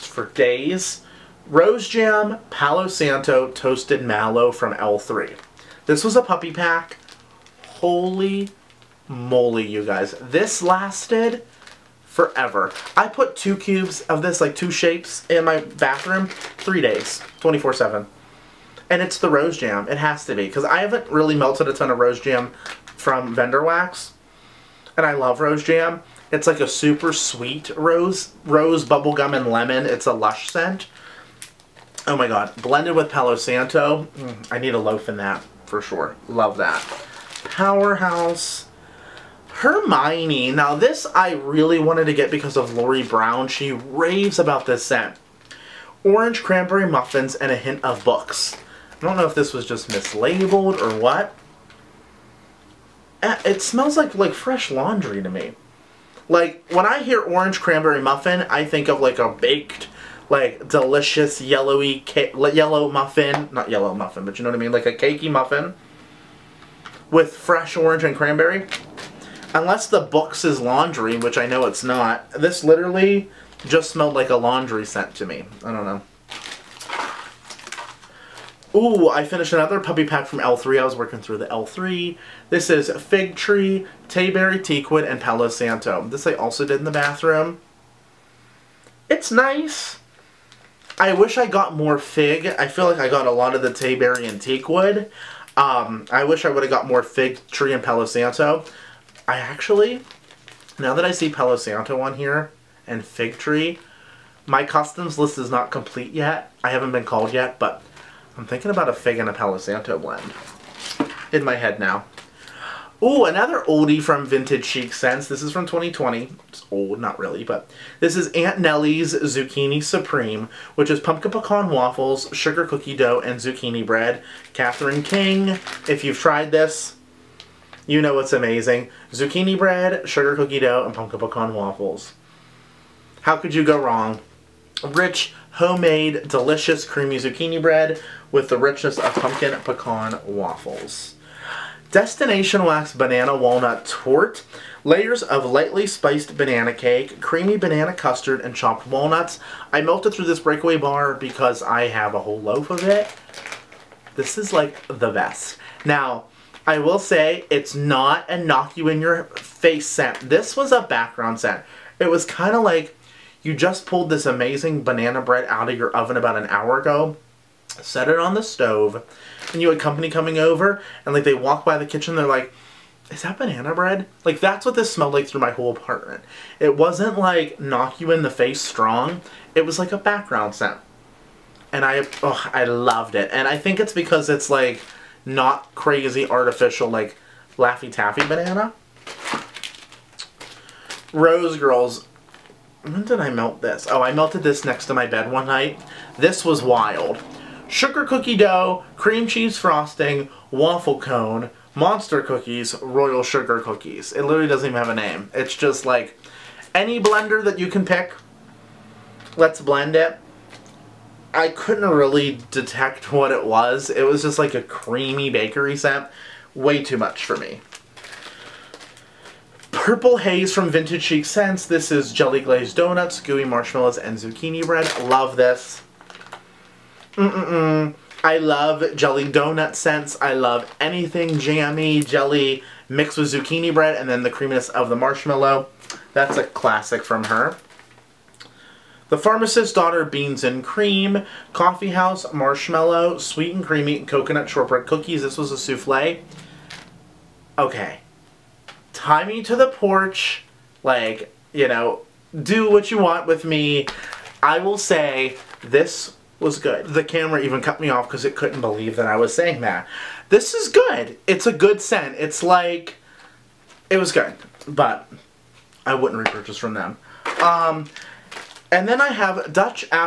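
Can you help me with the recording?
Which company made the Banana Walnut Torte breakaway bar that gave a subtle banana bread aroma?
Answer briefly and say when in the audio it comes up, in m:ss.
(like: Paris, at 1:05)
Destination Wax, at 2:21.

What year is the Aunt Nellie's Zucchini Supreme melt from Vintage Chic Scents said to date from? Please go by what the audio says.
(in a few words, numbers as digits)
2020.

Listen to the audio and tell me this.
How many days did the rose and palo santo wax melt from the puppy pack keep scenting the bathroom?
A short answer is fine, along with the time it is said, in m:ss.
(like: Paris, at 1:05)
3, at 0:16.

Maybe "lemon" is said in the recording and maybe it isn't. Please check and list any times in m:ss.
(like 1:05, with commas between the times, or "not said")
0:29.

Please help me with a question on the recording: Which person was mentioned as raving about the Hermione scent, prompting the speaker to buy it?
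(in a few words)
Lori Brown.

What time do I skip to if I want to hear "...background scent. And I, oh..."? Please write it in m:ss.
2:59.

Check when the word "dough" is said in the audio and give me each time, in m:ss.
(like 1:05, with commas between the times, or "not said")
2:02, 2:10, 3:18.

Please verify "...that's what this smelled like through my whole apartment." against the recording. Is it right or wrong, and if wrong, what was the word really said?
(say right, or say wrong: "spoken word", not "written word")
right.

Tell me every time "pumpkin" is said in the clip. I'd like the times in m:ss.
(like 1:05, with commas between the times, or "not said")
2:00, 2:10, 2:19.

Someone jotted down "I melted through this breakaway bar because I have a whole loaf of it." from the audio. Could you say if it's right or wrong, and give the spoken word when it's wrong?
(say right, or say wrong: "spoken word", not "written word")
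right.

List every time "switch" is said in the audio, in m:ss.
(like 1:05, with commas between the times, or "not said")
not said.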